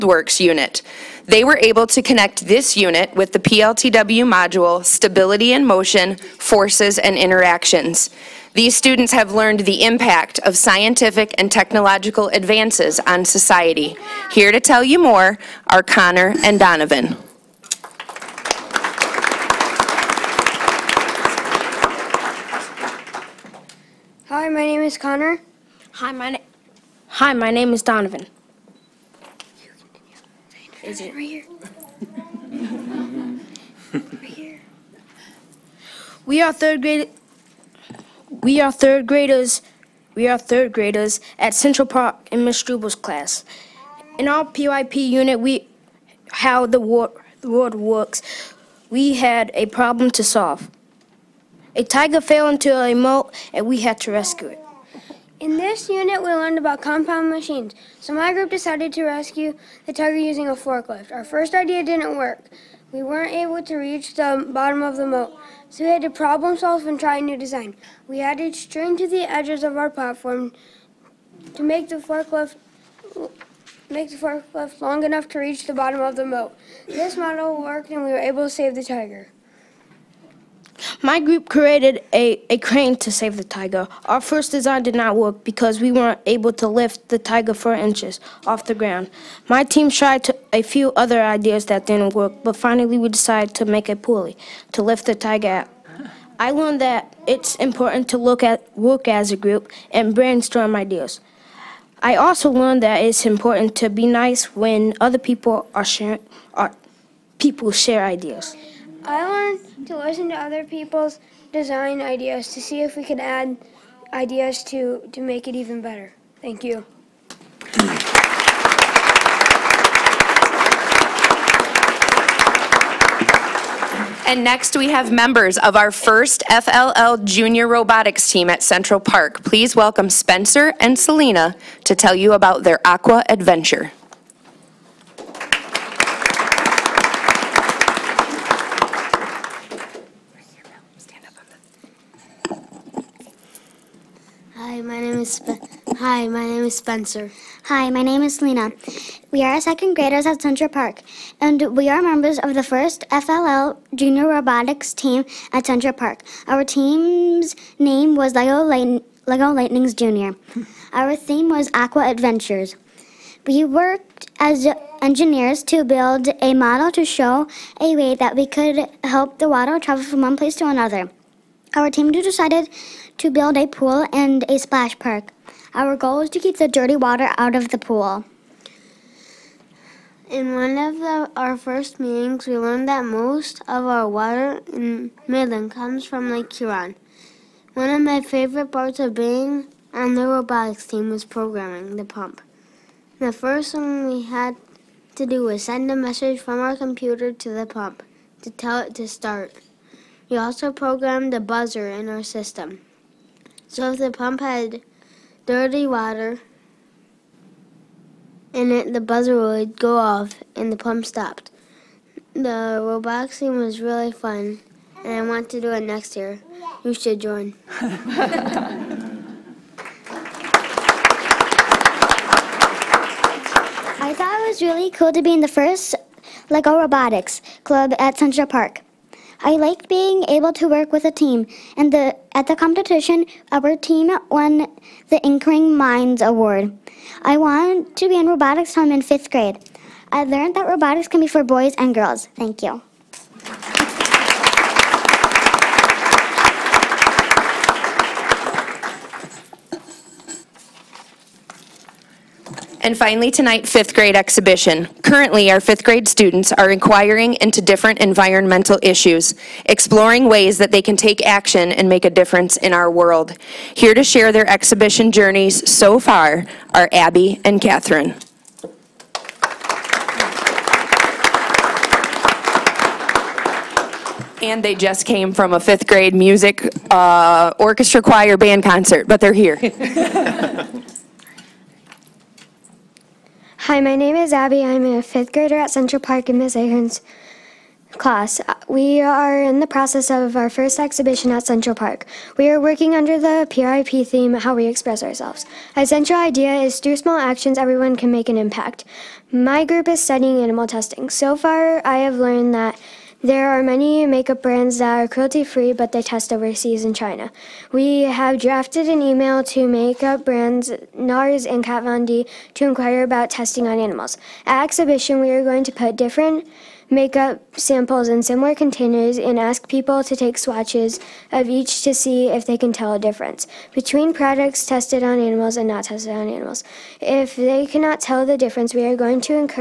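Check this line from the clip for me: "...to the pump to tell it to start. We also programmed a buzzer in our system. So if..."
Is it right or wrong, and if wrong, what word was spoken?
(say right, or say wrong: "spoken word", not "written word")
right.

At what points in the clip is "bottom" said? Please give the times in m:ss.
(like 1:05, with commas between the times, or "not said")
1:04, 1:15.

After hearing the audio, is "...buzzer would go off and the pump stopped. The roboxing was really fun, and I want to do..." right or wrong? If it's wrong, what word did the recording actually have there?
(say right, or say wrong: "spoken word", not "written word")
right.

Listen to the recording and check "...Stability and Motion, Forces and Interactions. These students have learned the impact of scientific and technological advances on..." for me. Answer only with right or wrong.
right.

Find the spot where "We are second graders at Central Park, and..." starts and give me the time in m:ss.
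2:29.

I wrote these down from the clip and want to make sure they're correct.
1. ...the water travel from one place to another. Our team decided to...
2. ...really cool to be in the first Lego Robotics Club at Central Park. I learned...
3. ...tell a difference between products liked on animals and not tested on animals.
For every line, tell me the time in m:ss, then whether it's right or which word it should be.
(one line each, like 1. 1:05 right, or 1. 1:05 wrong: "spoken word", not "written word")
1. 2:49 right
2. 3:44 wrong: "liked", not "learned"
3. 5:22 wrong: "tested", not "liked".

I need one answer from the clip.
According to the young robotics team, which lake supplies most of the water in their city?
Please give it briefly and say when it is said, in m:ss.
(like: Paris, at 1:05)
Lake Huron, at 3:06.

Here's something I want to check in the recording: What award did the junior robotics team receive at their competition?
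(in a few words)
Inkering Minds Award.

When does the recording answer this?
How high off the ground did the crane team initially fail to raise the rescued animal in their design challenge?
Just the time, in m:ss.
1:27.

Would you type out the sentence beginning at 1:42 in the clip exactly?
I also learned that it's important to be nice when other people are sharing, are, people share ideas.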